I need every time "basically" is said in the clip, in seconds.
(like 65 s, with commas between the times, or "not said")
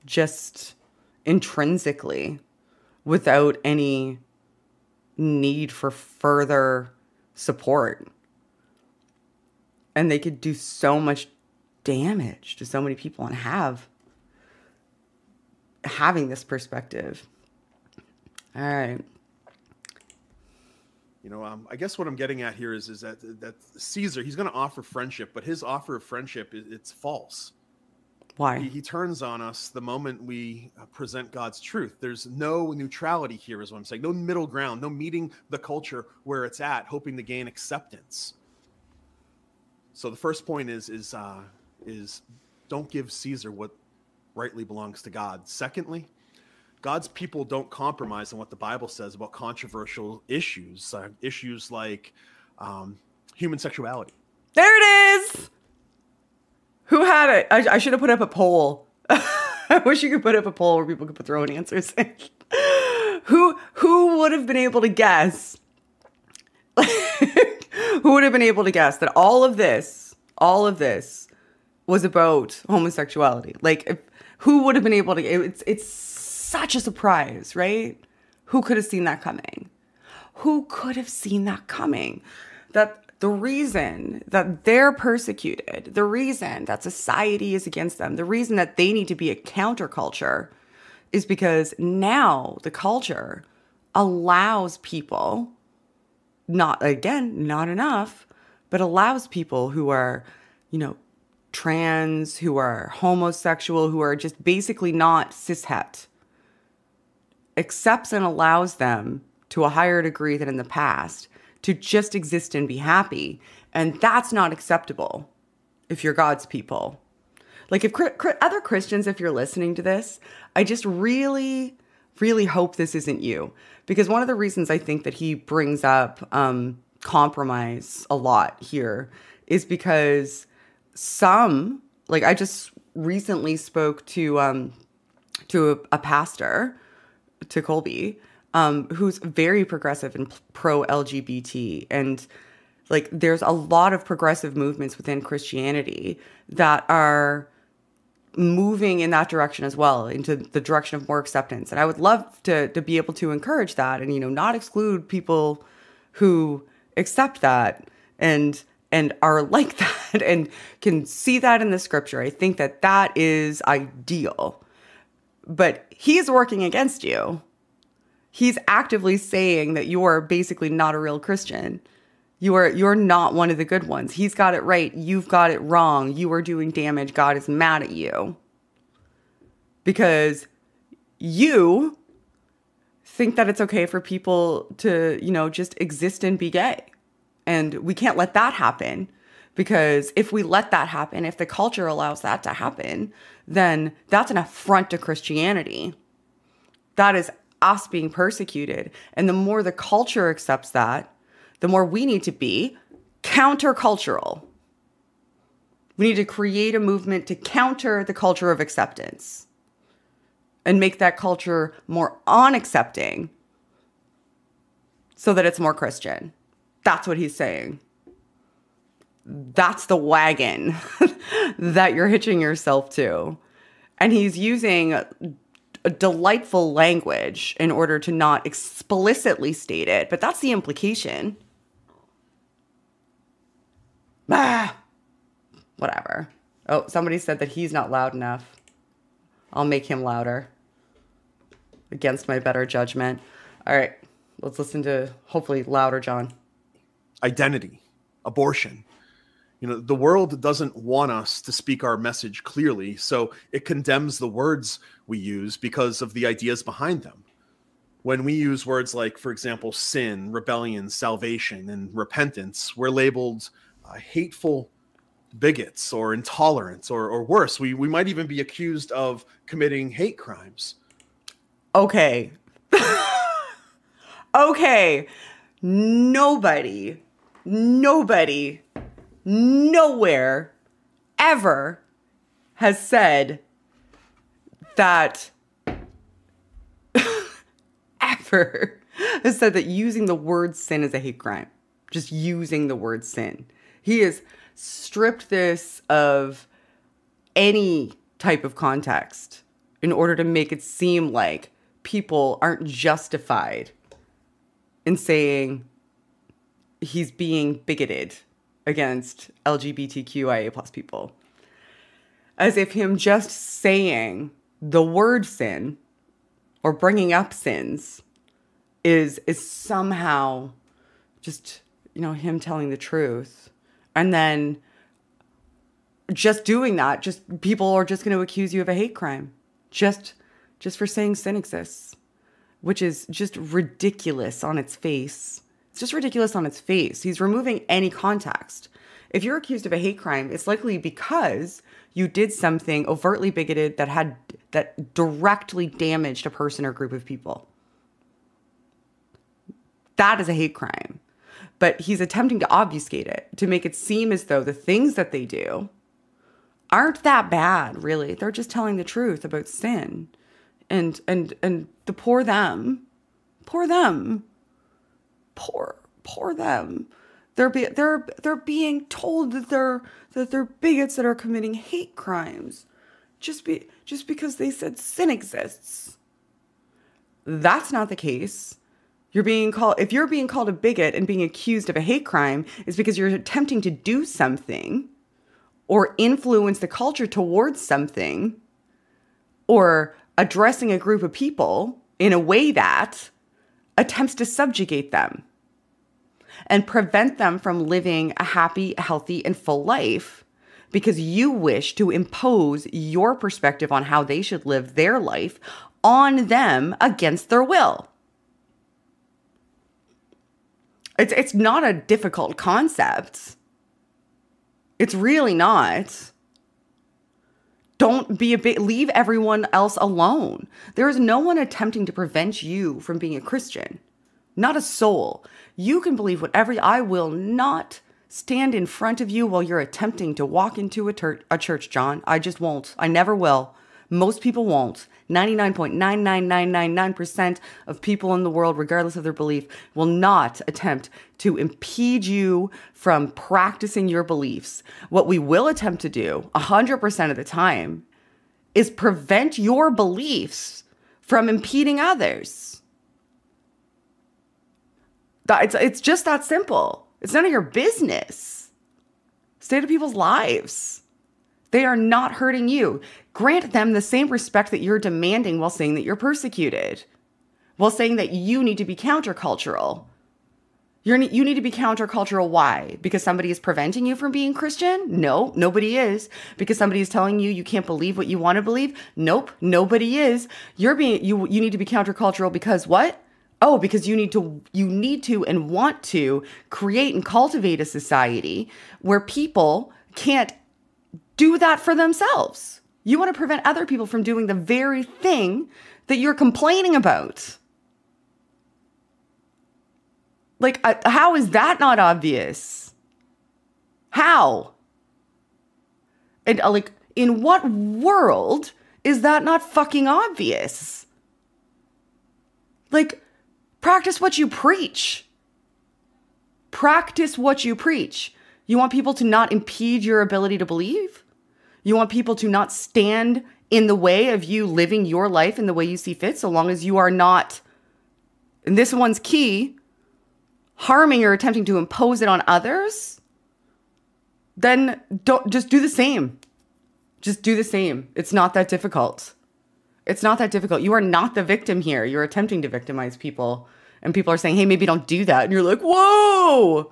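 104 s, 170 s.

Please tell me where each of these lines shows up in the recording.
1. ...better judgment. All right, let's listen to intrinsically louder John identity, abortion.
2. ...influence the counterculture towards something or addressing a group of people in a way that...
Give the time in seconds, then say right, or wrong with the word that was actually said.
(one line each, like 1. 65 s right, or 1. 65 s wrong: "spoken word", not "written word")
1. 242 s wrong: "hopefully", not "intrinsically"
2. 385 s wrong: "culture", not "counterculture".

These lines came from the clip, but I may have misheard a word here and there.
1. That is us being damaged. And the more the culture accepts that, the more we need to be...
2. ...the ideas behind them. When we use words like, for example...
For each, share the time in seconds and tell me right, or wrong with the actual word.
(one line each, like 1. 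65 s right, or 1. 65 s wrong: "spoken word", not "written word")
1. 196 s wrong: "persecuted", not "damaged"
2. 256 s right.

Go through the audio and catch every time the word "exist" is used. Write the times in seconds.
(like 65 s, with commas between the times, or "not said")
112 s, 185 s, 331 s, 375 s.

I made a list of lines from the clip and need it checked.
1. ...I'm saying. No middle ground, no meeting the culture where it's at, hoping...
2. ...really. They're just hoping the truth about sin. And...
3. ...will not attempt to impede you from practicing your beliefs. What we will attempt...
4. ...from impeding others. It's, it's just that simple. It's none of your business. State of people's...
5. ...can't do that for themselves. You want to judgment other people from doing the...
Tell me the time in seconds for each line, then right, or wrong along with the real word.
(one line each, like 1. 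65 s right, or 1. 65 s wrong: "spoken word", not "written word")
1. 33 s right
2. 357 s wrong: "telling", not "hoping"
3. 439 s right
4. 451 s right
5. 489 s wrong: "prevent", not "judgment".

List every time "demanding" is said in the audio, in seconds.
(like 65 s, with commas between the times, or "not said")
464 s.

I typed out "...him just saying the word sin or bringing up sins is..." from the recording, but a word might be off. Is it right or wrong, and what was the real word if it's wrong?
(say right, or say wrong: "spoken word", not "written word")
right.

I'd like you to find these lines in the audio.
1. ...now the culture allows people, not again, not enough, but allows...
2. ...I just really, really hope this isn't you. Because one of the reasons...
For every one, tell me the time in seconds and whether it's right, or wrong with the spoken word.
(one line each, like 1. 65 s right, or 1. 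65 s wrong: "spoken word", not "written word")
1. 91 s right
2. 120 s right.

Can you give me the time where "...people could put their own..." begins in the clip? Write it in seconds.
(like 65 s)
60 s.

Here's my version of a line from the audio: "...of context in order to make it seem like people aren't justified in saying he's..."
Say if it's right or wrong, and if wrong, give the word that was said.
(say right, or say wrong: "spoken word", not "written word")
right.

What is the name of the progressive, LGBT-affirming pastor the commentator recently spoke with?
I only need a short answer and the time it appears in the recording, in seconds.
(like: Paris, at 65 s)
Colby, at 137 s.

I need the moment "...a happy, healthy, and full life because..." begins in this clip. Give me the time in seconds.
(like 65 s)
398 s.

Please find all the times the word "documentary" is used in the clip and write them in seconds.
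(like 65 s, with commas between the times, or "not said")
not said.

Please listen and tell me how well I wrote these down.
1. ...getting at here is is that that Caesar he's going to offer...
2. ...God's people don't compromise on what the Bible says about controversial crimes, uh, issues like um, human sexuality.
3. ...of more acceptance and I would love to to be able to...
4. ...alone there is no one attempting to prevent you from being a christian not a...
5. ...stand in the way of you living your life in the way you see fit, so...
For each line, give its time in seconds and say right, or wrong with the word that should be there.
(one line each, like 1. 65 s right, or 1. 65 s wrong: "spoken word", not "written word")
1. 22 s right
2. 46 s wrong: "issues", not "crimes"
3. 150 s right
4. 419 s right
5. 522 s right.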